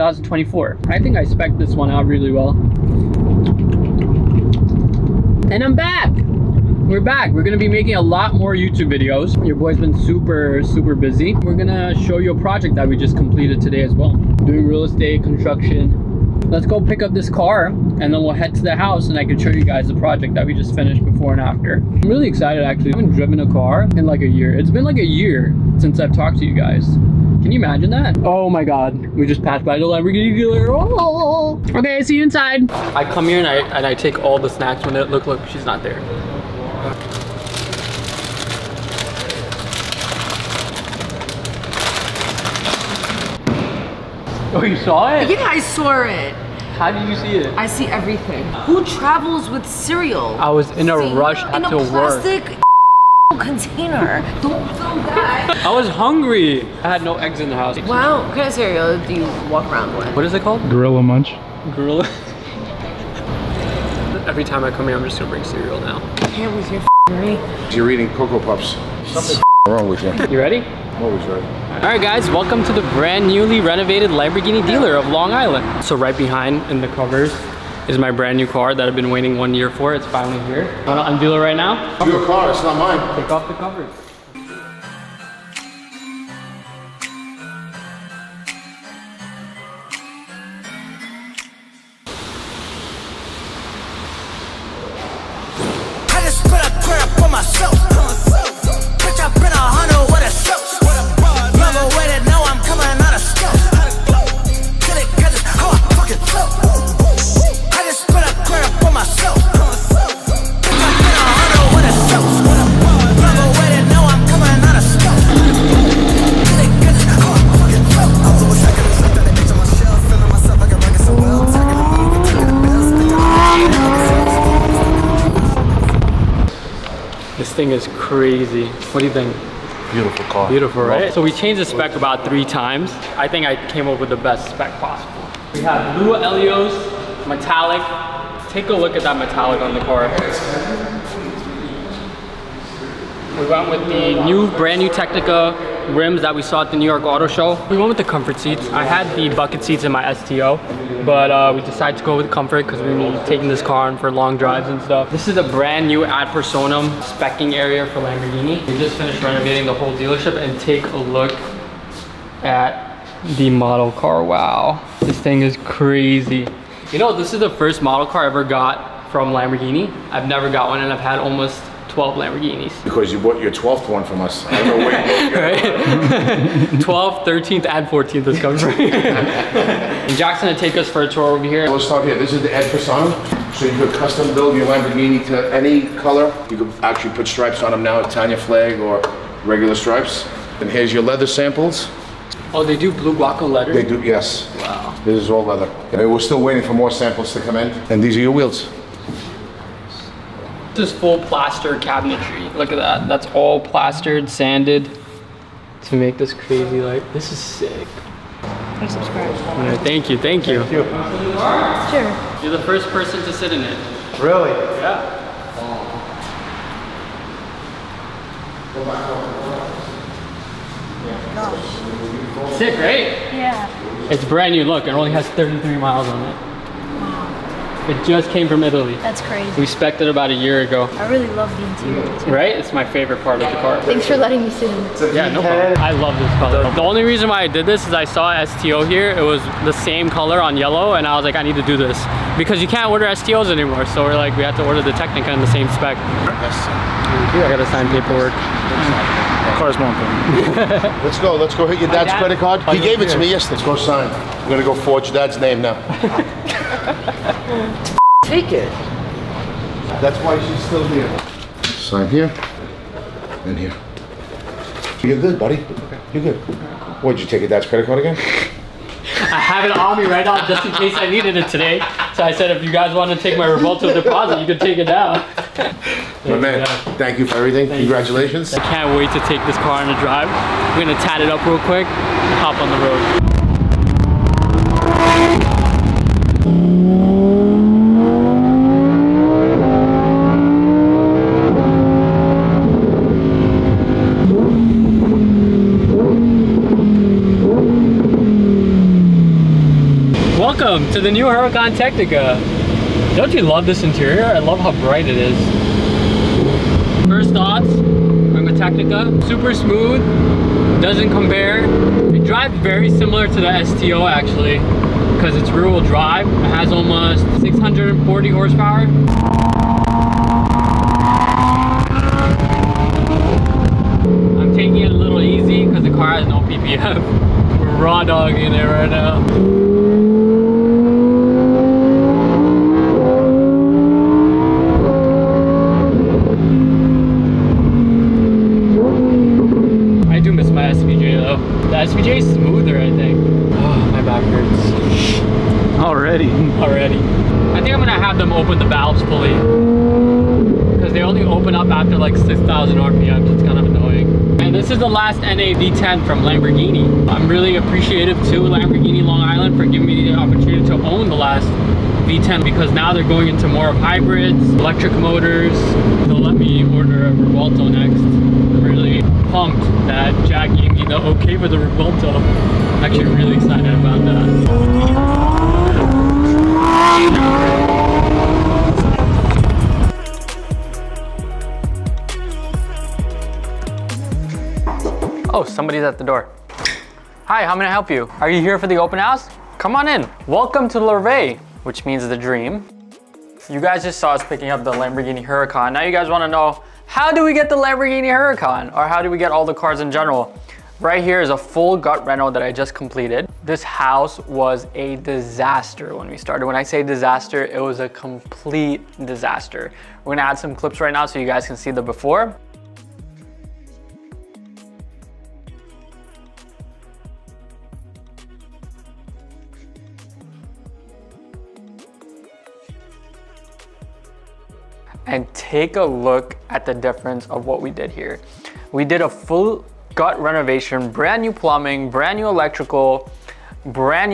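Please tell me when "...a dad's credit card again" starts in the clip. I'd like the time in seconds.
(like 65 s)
267 s.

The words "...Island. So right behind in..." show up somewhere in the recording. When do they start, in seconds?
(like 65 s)
75 s.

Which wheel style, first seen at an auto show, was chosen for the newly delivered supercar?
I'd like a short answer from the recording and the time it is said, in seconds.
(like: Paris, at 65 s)
Tecnica rims, at 144 s.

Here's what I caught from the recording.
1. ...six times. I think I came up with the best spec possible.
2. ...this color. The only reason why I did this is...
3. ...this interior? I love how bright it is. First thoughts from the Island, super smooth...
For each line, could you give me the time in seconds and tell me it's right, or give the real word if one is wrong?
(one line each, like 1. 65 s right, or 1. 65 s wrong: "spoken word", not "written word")
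1. 132 s wrong: "three", not "six"
2. 236 s right
3. 303 s wrong: "Tecnica", not "Island".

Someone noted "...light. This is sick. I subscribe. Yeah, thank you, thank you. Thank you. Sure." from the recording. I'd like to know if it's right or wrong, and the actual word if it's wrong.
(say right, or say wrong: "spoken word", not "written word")
right.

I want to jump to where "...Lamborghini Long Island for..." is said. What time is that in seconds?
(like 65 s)
358 s.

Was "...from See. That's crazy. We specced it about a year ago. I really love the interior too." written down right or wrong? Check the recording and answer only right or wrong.
wrong.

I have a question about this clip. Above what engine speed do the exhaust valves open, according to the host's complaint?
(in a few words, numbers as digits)
6,000 RPM.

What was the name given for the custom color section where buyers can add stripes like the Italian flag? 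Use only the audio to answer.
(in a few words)
Ed Fasano.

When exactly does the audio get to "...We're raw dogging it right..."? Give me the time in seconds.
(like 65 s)
327 s.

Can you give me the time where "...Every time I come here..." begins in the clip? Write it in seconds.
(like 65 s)
64 s.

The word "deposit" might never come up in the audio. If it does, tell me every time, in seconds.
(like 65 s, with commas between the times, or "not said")
273 s.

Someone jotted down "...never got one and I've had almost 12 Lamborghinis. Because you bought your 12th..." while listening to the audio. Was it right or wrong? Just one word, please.
right.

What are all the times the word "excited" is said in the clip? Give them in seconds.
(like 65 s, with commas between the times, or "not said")
22 s, 373 s.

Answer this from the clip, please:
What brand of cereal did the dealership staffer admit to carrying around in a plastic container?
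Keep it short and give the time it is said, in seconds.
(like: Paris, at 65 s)
Gorilla Munch, at 60 s.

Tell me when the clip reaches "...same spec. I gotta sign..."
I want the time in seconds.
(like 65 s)
245 s.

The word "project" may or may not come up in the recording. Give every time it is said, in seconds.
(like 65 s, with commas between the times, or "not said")
12 s, 19 s.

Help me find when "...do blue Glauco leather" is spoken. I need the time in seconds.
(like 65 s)
192 s.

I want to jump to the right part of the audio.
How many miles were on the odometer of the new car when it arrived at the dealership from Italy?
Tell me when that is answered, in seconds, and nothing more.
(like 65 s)
225 s.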